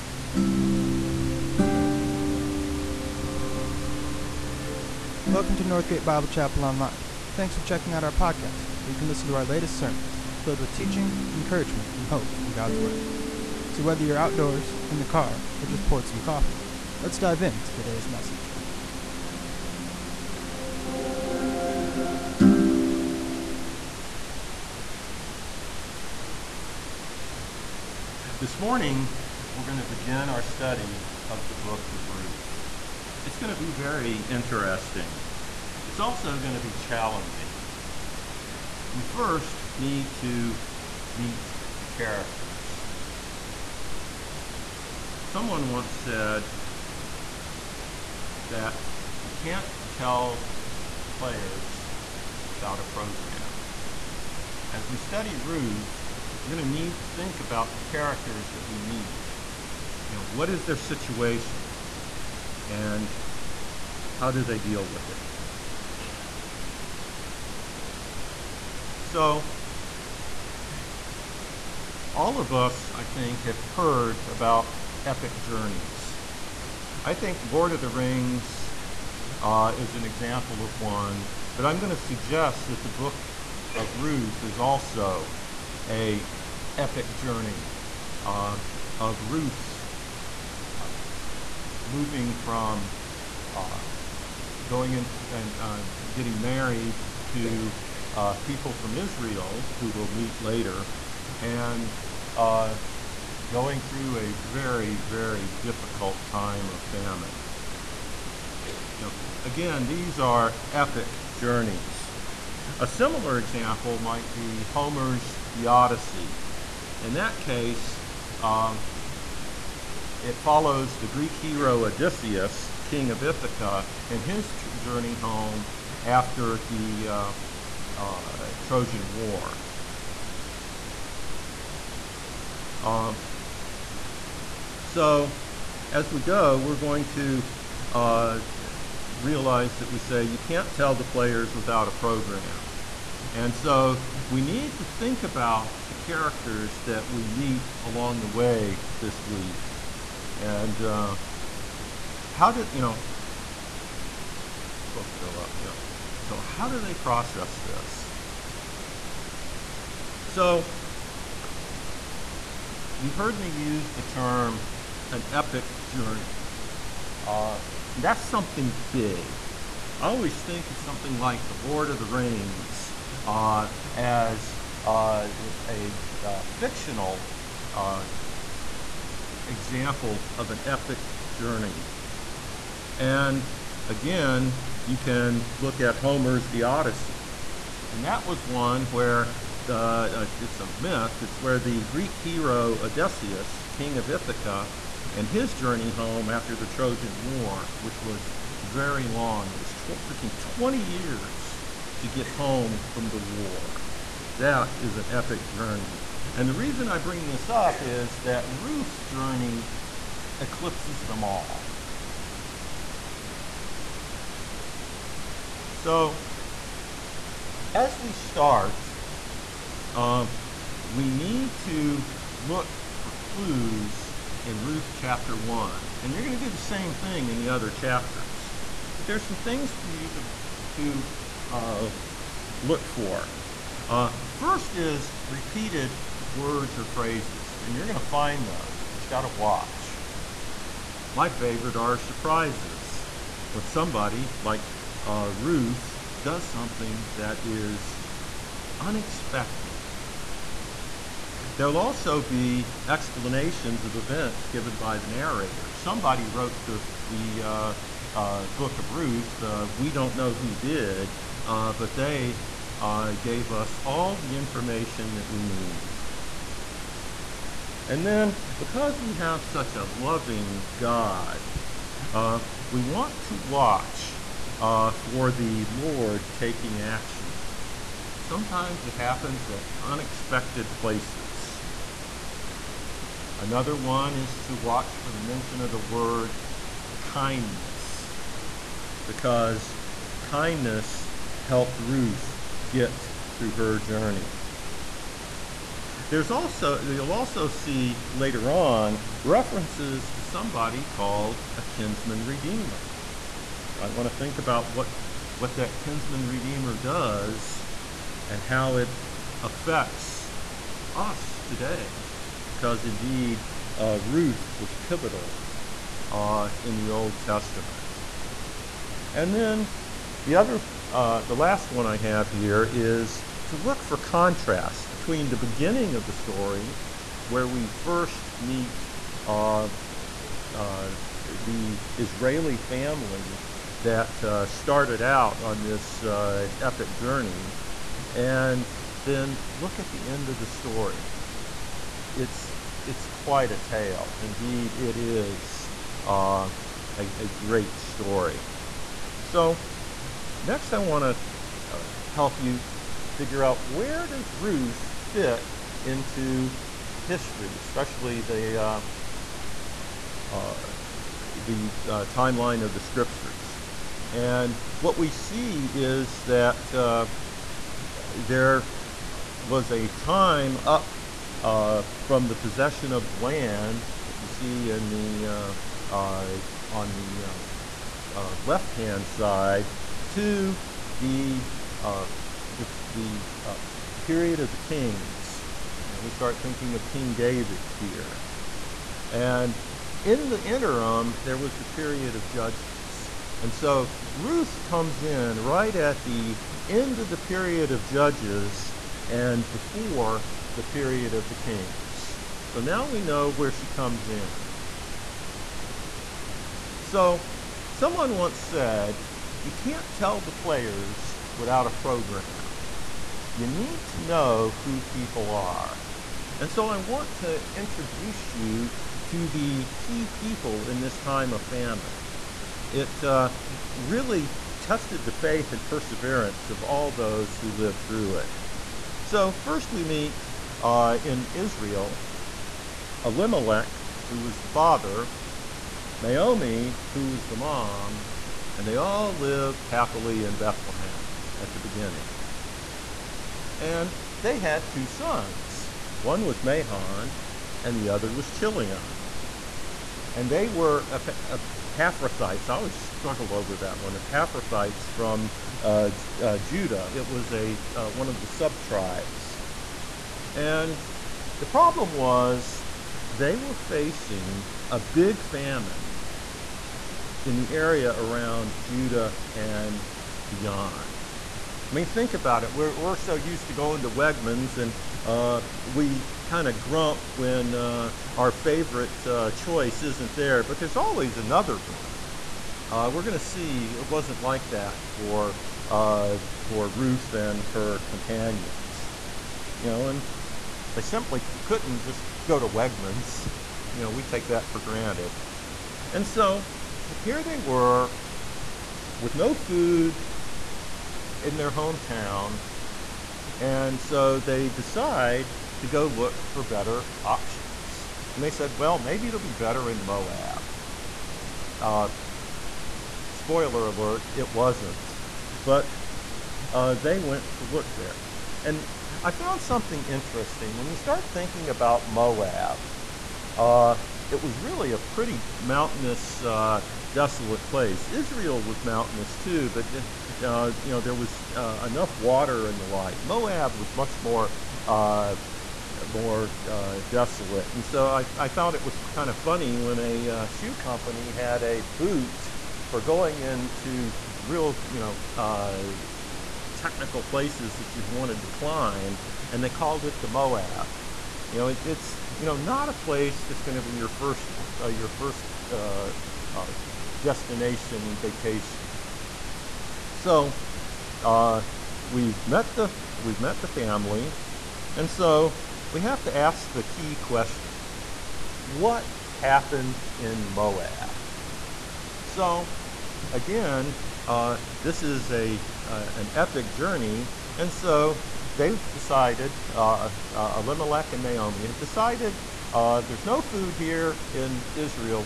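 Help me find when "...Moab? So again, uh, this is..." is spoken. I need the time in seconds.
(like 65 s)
570 s.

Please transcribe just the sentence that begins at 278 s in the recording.
Sometimes it happens at unexpected places.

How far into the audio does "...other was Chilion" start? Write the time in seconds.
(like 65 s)
447 s.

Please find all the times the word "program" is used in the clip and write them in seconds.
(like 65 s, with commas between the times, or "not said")
52 s, 141 s, 411 s.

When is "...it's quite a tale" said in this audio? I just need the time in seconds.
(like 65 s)
342 s.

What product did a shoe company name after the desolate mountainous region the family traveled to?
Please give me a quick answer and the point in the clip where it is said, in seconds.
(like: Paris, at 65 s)
a boot, at 541 s.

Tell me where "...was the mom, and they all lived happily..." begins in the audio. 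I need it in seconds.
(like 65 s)
437 s.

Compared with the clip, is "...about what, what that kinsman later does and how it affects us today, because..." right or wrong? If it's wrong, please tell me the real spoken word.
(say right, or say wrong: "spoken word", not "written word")
wrong: "redeemer", not "later".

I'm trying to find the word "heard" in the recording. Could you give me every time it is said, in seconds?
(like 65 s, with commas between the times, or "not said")
73 s, 163 s.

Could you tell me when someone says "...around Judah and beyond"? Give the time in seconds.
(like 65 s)
467 s.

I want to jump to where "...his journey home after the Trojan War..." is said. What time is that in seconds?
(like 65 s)
195 s.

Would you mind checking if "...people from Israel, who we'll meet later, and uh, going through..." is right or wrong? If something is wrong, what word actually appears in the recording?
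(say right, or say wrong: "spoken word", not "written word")
right.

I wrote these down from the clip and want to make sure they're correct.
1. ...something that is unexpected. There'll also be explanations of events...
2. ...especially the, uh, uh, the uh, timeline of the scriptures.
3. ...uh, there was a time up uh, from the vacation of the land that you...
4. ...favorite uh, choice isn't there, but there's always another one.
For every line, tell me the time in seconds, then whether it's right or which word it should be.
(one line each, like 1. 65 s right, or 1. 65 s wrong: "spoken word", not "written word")
1. 246 s right
2. 357 s right
3. 366 s wrong: "possession", not "vacation"
4. 478 s right.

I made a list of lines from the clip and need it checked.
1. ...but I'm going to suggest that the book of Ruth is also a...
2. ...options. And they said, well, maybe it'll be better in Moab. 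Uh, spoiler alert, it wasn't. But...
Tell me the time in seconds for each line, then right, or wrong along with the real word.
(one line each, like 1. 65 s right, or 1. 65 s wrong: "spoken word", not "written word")
1. 81 s right
2. 507 s right.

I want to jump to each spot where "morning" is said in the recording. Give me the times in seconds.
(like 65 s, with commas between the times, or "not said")
28 s.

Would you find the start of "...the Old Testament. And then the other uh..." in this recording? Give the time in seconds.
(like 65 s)
316 s.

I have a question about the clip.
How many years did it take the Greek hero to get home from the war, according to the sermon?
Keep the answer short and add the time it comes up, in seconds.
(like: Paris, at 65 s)
20, at 200 s.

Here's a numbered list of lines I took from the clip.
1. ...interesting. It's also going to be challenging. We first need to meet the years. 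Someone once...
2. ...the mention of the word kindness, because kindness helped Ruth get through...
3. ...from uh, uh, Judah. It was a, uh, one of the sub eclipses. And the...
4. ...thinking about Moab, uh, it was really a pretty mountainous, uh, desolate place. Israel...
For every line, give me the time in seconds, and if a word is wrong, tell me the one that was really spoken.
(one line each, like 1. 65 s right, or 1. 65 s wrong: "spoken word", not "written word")
1. 34 s wrong: "characters", not "years"
2. 285 s right
3. 454 s wrong: "tribes", not "eclipses"
4. 521 s right.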